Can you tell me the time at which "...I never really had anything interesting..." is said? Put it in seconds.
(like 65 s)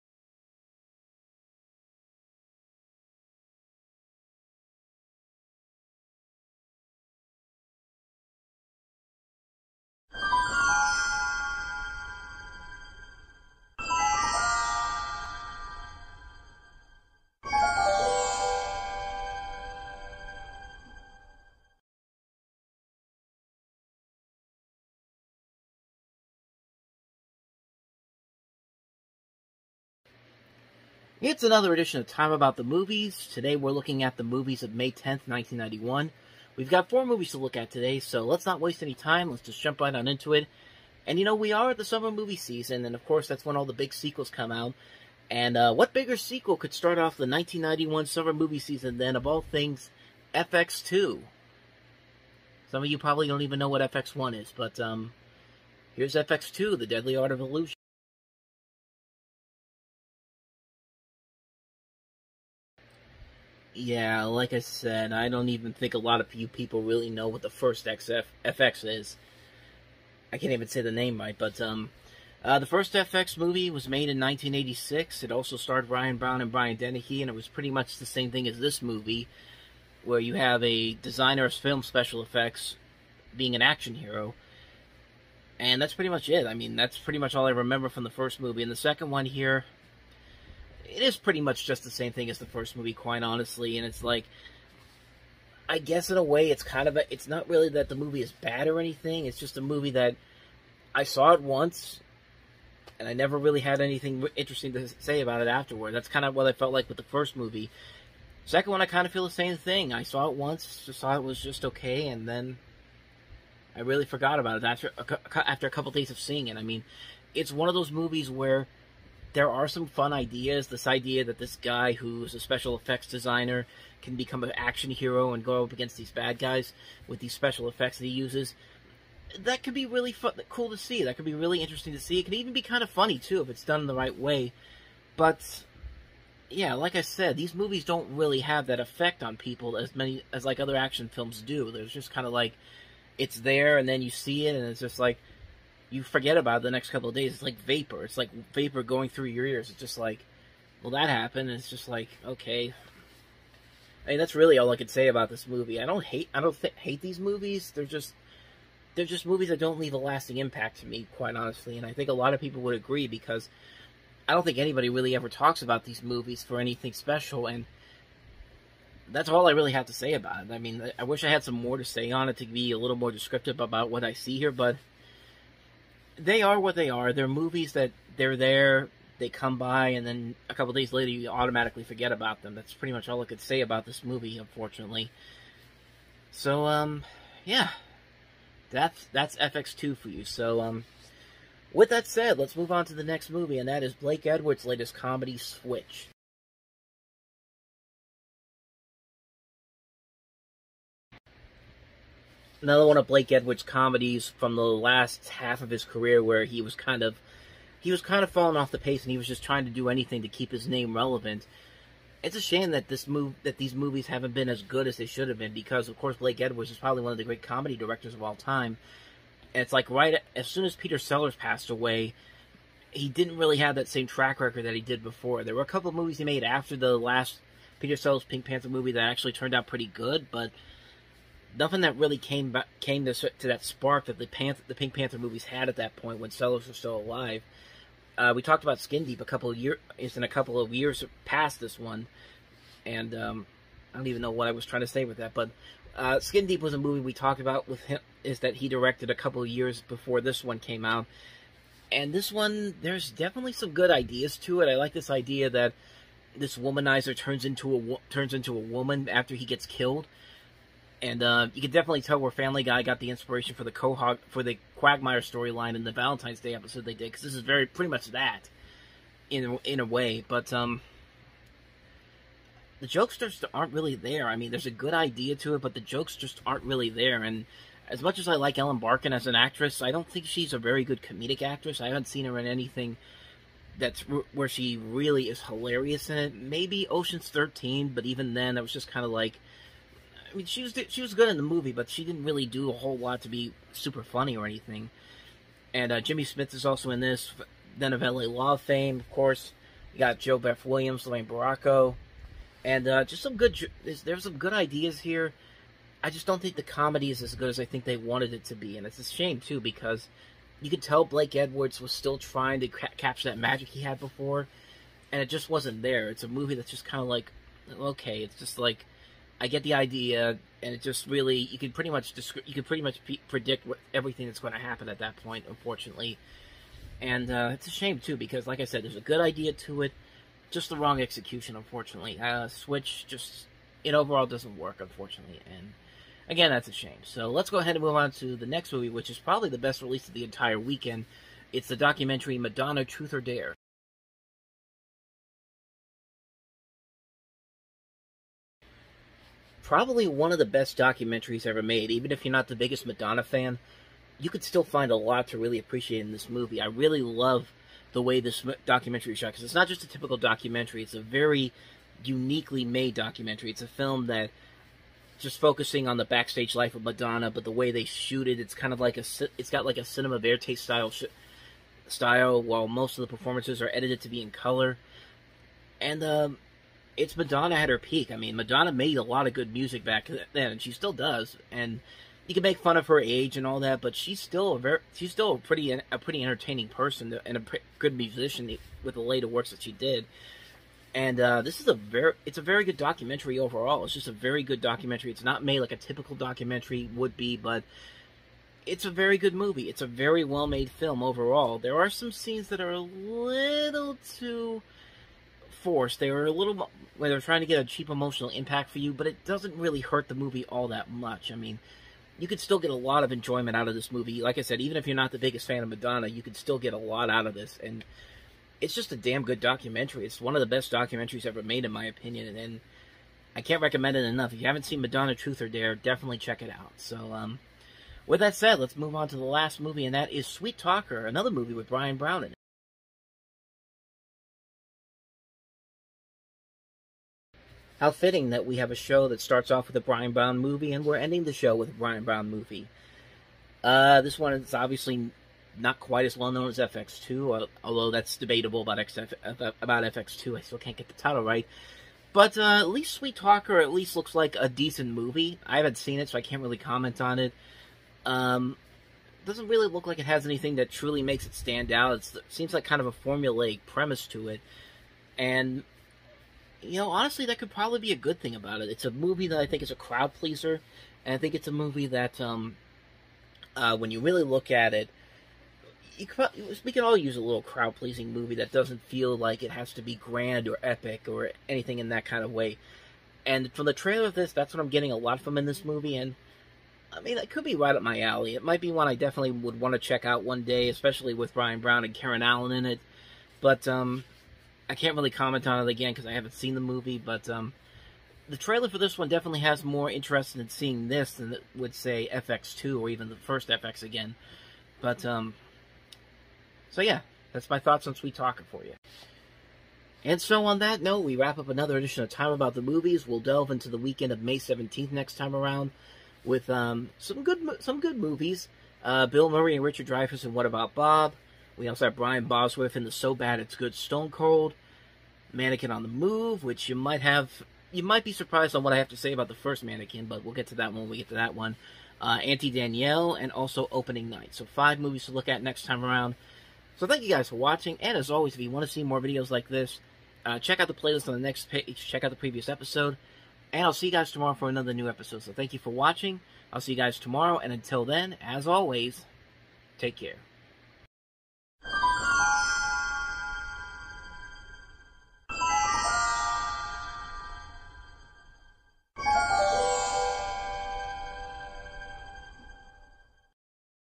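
103 s.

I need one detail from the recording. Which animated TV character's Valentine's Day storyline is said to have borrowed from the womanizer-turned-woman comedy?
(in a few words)
Quagmire.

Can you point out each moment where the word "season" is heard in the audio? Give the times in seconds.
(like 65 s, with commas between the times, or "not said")
42 s, 48 s.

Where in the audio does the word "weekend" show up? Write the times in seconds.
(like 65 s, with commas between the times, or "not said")
340 s, 513 s.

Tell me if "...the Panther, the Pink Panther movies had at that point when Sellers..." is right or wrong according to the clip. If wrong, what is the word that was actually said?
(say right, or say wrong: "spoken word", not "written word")
right.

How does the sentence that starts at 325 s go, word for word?
Unfortunately, and uh, it's a shame too because, like I said, there's a good idea to it, just the wrong execution.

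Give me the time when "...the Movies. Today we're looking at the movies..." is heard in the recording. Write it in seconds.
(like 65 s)
32 s.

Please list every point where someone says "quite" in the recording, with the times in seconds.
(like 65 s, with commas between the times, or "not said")
92 s, 161 s, 445 s.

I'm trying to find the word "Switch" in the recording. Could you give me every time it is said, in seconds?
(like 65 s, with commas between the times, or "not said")
195 s, 332 s.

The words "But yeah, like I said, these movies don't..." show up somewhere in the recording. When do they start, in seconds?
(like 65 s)
135 s.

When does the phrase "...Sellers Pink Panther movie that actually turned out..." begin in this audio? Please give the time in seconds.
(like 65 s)
227 s.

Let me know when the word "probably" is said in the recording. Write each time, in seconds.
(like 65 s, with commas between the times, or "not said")
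52 s, 216 s, 339 s, 349 s, 467 s.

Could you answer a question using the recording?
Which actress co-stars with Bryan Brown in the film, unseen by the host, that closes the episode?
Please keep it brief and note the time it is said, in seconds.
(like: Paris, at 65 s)
Karen Allen, at 491 s.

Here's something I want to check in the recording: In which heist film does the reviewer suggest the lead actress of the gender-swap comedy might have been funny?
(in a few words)
Ocean's 13.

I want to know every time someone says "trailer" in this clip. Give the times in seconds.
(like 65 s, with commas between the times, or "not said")
483 s, 498 s.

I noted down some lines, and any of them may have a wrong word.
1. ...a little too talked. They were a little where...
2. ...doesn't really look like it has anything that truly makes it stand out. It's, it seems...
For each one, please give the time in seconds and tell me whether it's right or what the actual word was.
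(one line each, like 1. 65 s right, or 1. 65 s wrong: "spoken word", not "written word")
1. 402 s wrong: "forced", not "talked"
2. 459 s right.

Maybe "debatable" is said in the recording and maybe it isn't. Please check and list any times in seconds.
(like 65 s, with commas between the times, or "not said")
448 s.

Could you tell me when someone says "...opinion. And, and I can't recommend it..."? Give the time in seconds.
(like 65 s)
421 s.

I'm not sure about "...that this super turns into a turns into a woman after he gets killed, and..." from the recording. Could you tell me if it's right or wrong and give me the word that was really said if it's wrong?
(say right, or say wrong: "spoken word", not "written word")
wrong: "womanizer", not "super".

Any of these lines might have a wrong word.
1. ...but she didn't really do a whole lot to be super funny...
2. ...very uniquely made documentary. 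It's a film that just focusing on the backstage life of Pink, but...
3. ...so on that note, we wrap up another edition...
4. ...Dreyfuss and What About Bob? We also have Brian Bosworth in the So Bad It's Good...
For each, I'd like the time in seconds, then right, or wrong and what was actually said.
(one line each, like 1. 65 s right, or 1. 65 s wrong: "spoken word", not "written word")
1. 291 s right
2. 360 s wrong: "Madonna", not "Pink"
3. 510 s right
4. 519 s right.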